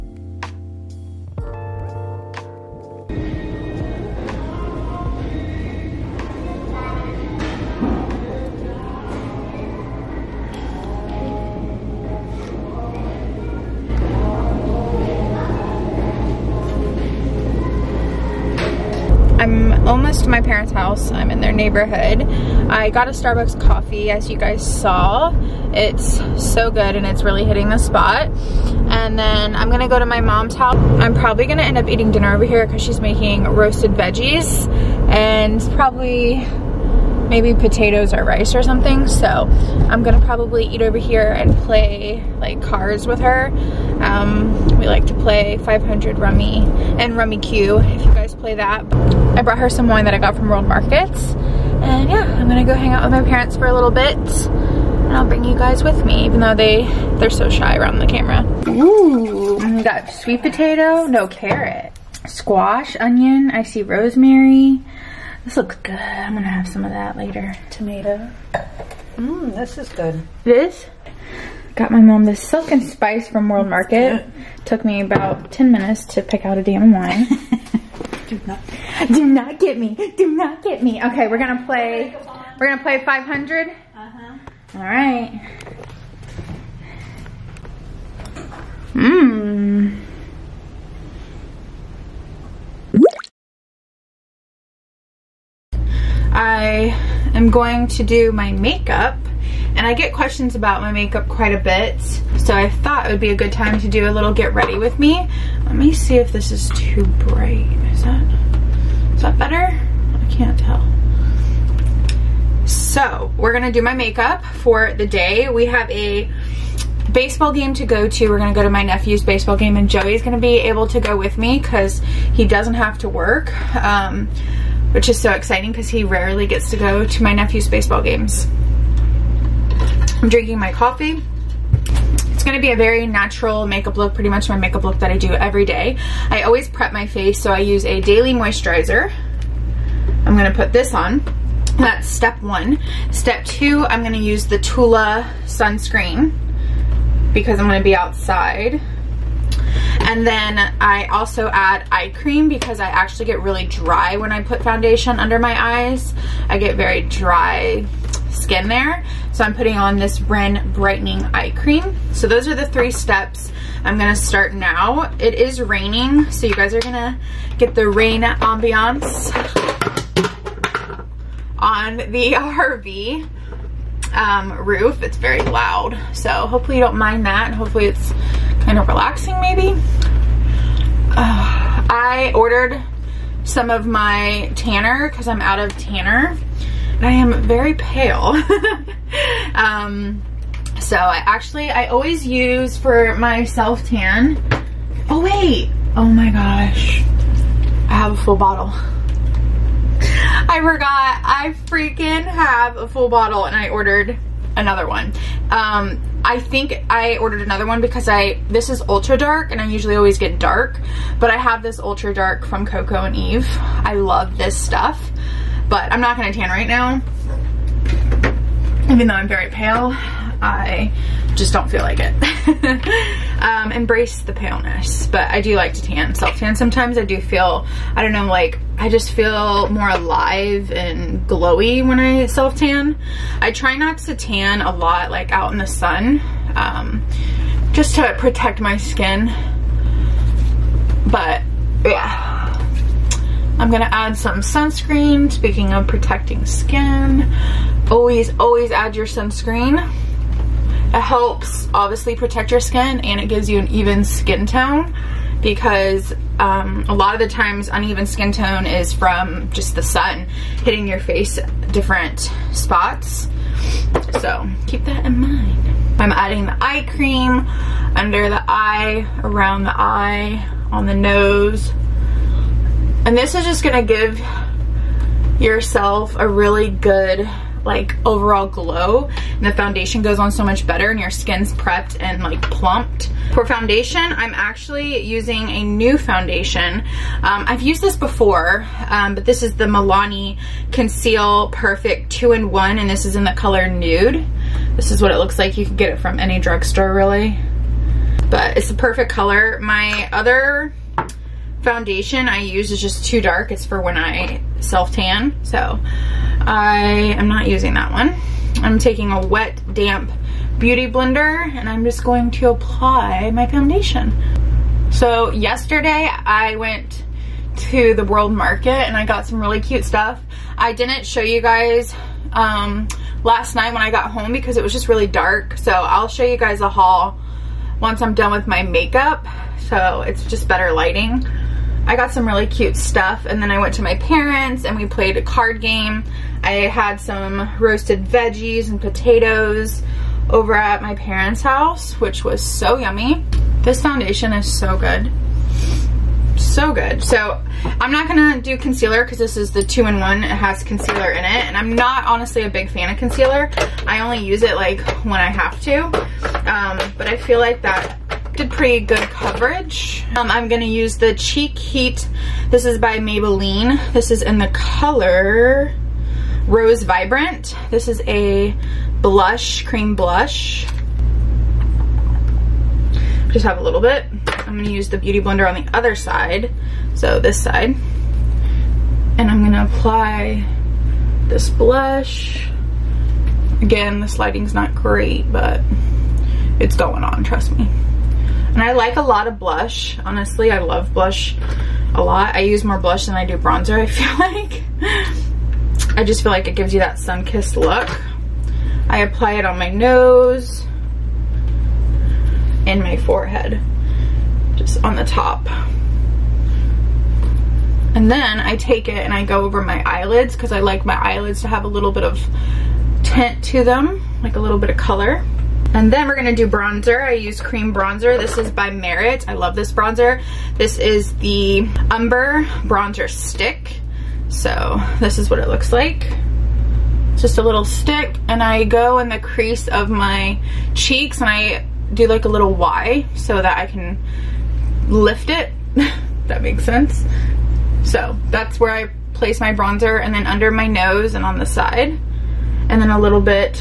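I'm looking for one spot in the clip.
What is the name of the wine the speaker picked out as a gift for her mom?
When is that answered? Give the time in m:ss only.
1:12.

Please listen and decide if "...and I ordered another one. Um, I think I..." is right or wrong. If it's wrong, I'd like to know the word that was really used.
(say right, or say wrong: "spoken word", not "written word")
right.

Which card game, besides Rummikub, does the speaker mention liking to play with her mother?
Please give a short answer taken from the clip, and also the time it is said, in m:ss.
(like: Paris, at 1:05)
500 Rummy, at 0:45.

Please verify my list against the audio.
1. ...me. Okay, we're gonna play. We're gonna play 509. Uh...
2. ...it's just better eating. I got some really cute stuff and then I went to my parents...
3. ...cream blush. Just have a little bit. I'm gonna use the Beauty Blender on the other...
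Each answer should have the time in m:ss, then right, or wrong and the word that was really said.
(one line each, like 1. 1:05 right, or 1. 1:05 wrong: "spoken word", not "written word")
1. 1:20 wrong: "500", not "509"
2. 5:30 wrong: "lighting", not "eating"
3. 6:09 right.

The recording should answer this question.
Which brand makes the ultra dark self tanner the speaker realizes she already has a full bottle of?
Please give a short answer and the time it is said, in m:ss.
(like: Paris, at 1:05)
Coco and Eve, at 3:32.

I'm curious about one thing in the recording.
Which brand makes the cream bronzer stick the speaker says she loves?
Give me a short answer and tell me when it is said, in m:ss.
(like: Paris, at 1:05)
Merit, at 6:58.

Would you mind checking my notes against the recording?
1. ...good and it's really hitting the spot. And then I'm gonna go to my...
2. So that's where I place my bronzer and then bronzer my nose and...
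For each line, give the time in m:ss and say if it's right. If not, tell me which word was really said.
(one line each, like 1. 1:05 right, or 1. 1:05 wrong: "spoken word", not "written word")
1. 0:26 right
2. 7:17 wrong: "under", not "bronzer".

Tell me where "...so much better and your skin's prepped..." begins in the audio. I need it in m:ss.
4:40.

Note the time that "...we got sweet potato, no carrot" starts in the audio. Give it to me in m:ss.
0:59.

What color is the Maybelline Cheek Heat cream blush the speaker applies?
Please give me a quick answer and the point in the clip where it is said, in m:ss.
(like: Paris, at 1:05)
Rose Vibrant, at 6:06.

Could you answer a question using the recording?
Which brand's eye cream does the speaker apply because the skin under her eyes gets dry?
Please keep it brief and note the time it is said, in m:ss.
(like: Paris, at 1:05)
Ren, at 2:40.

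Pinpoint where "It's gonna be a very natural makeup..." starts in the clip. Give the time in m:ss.
2:12.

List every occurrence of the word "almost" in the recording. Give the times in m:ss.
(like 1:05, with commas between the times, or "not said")
0:19.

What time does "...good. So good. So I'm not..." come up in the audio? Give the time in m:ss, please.
5:44.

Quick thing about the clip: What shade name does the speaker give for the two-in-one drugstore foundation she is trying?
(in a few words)
Nude.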